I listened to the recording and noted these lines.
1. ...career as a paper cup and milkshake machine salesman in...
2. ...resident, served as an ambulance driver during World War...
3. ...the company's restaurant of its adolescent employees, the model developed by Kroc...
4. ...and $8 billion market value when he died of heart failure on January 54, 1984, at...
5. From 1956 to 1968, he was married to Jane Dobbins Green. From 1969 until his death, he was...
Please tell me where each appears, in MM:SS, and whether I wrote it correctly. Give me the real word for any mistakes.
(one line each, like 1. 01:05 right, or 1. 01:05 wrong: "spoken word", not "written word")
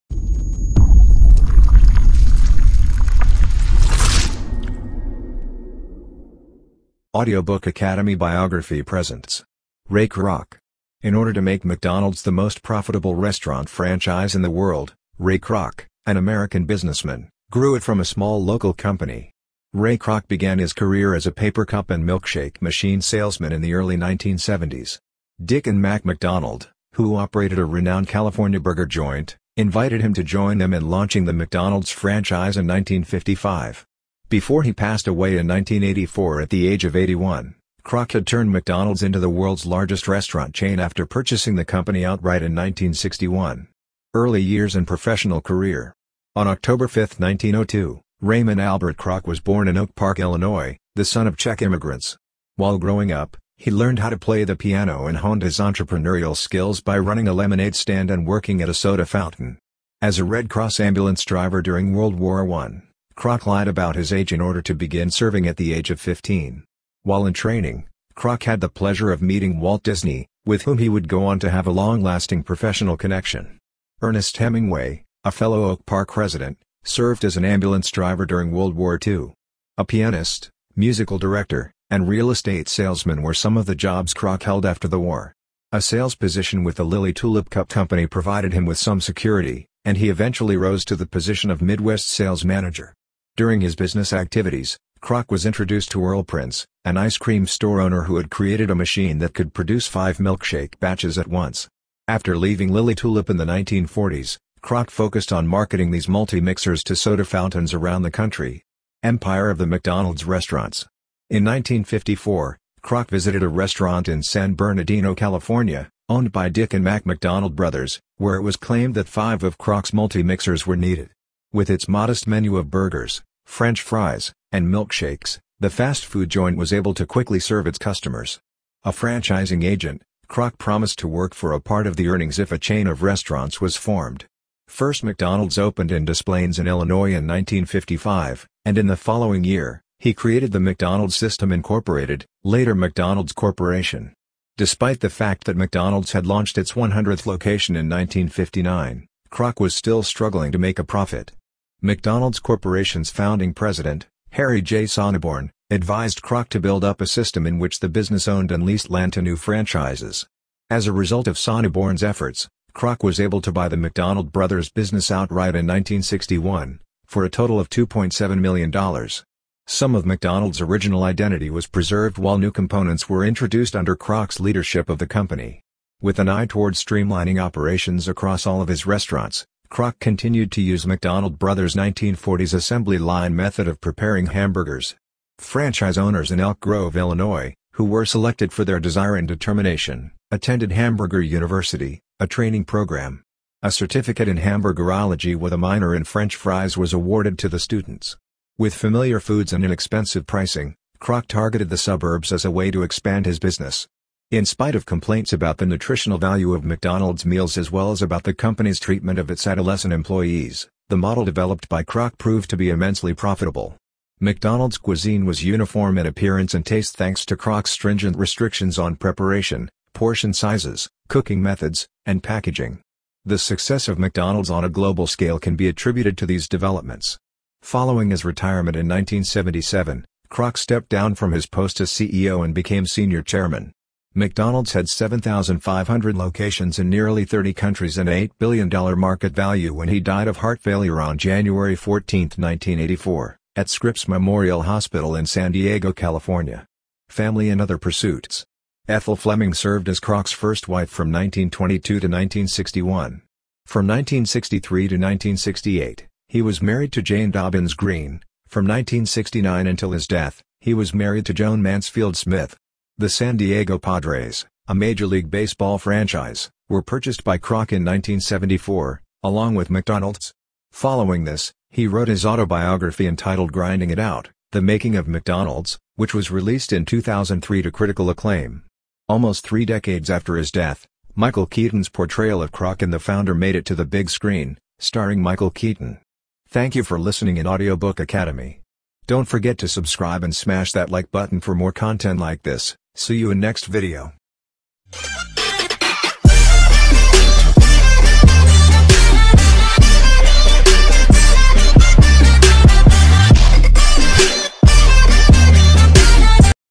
1. 00:20 right
2. 01:16 right
3. 03:28 wrong: "treatment", not "restaurant"
4. 03:57 wrong: "14", not "54"
5. 04:13 wrong: "1963", not "1956".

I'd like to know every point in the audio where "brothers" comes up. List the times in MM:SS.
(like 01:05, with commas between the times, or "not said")
01:57, 02:44, 03:01.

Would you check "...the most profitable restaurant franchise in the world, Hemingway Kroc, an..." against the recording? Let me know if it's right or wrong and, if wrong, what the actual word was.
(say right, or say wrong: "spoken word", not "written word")
wrong: "Ray", not "Hemingway".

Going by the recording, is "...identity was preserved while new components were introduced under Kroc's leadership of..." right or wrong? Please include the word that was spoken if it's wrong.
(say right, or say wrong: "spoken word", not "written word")
right.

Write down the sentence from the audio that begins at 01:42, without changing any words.
After leaving Lily Tulip in the 1940s, Kroc focused on marketing these multi-mixers to soda fountains around the country.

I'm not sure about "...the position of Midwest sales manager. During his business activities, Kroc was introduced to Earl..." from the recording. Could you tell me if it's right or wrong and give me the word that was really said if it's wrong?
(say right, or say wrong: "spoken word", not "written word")
right.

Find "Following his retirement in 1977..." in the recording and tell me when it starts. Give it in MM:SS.
03:47.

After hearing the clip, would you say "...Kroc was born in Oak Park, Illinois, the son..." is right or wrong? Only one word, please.
right.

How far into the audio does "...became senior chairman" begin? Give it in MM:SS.
03:52.